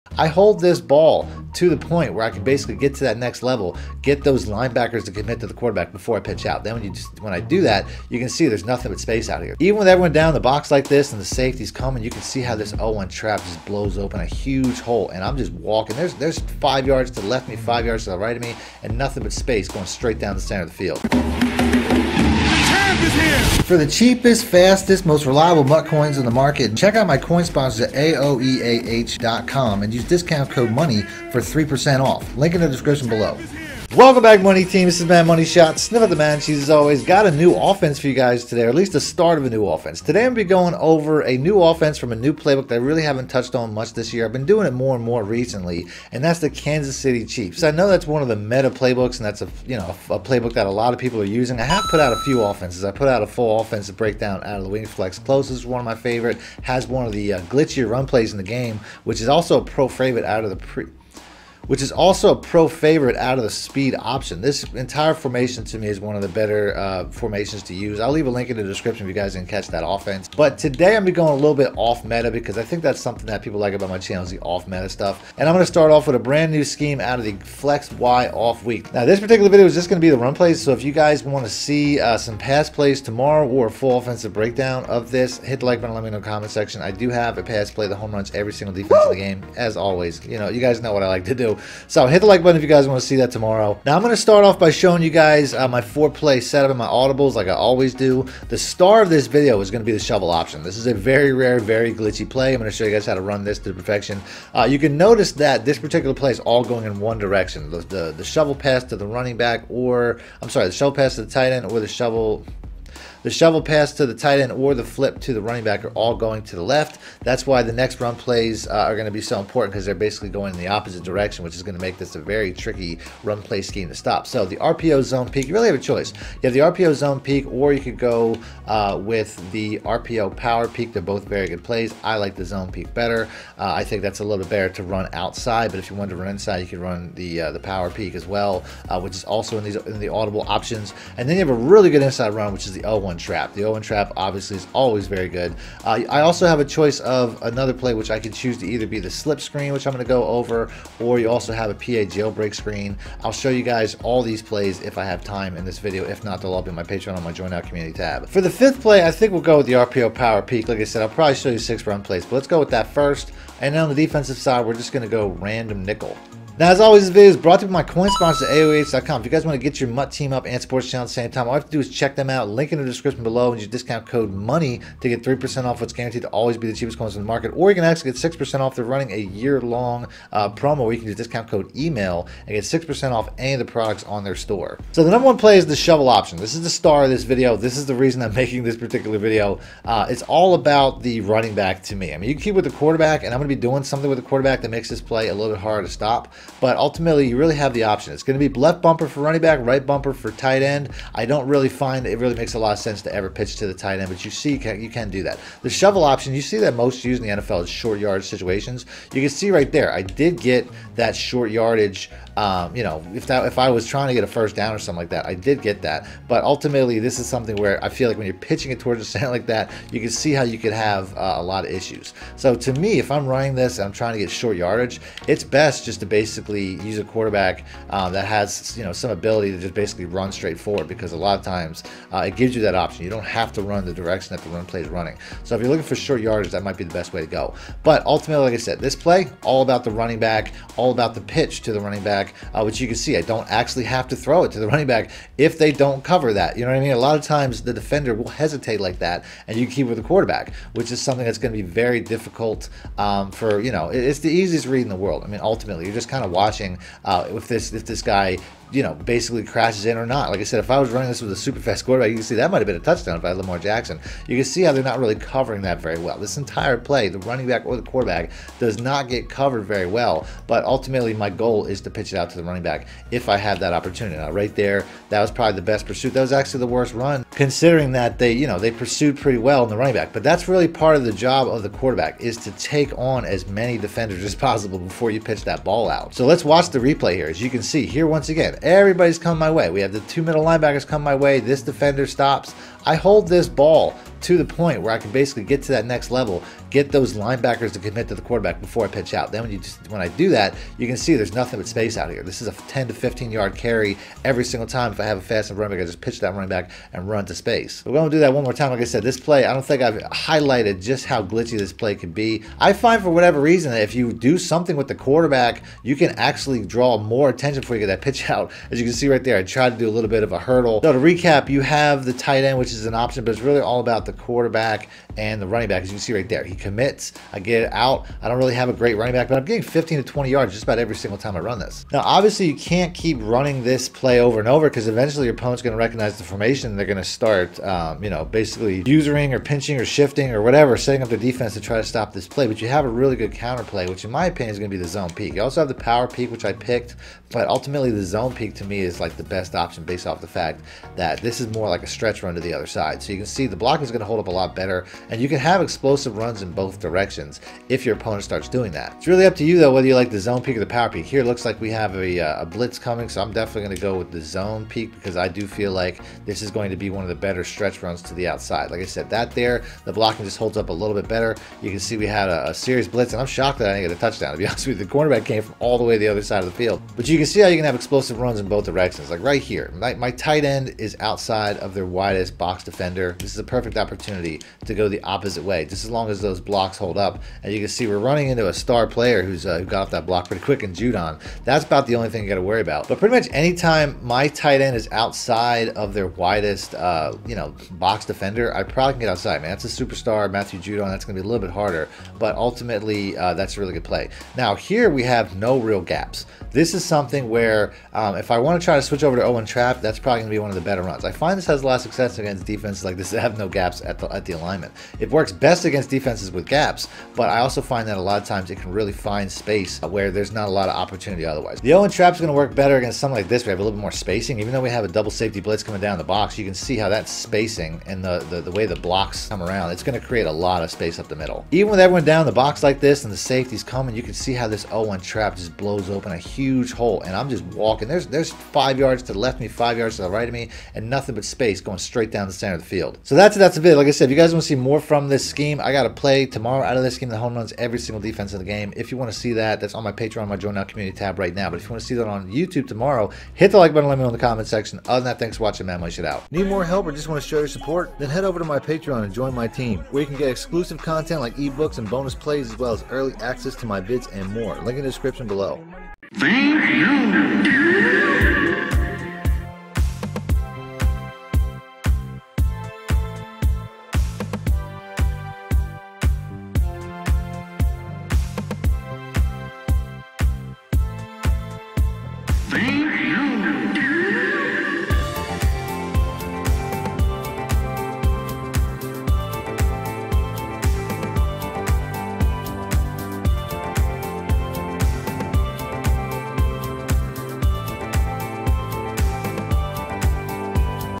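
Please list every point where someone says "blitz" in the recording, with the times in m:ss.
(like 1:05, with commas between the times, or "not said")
6:02, 6:12, 7:05.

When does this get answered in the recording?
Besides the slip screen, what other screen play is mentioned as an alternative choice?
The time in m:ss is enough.
2:31.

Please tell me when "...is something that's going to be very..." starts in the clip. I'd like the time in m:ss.
4:10.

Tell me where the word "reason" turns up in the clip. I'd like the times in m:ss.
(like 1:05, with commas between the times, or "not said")
3:07, 5:13.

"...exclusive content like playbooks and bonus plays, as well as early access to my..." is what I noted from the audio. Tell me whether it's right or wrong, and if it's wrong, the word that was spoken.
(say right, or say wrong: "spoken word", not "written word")
wrong: "ebooks", not "playbooks".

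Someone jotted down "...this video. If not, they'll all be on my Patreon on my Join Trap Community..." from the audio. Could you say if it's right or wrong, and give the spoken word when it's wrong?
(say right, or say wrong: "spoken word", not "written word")
wrong: "Out", not "Trap".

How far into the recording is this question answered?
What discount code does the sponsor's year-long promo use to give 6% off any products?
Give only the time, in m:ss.
3:01.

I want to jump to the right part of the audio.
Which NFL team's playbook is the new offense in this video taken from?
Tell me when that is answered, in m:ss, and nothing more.
0:46.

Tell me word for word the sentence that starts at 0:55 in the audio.
Close is one of my favorite.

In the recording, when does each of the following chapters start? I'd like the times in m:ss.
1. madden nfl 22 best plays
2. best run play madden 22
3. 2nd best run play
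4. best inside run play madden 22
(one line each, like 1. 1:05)
1. 1:15
2. 3:04
3. 5:38
4. 6:44.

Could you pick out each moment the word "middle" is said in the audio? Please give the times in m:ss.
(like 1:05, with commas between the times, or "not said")
4:50, 7:11.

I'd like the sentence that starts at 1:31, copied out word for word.
So hit the like button if you guys want to see that tomorrow.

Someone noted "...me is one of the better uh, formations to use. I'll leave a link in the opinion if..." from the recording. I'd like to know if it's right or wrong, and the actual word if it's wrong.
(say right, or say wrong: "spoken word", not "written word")
wrong: "description", not "opinion".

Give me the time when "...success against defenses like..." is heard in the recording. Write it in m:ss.
6:51.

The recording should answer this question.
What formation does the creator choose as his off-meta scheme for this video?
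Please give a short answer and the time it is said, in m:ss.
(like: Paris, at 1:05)
Flex Y off, at 1:17.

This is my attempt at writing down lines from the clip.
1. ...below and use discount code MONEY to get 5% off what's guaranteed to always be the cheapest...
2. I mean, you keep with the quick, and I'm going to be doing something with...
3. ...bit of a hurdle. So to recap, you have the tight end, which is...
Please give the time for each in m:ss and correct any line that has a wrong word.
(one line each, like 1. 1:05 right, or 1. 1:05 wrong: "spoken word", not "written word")
1. 2:53 wrong: "3", not "5"
2. 3:12 wrong: "quarterback", not "quick"
3. 5:20 right.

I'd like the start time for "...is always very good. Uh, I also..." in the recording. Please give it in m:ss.
2:24.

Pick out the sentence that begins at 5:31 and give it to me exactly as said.
Now, obviously, you can't keep running this play over and over because eventually your opponent's going to recognize the formation.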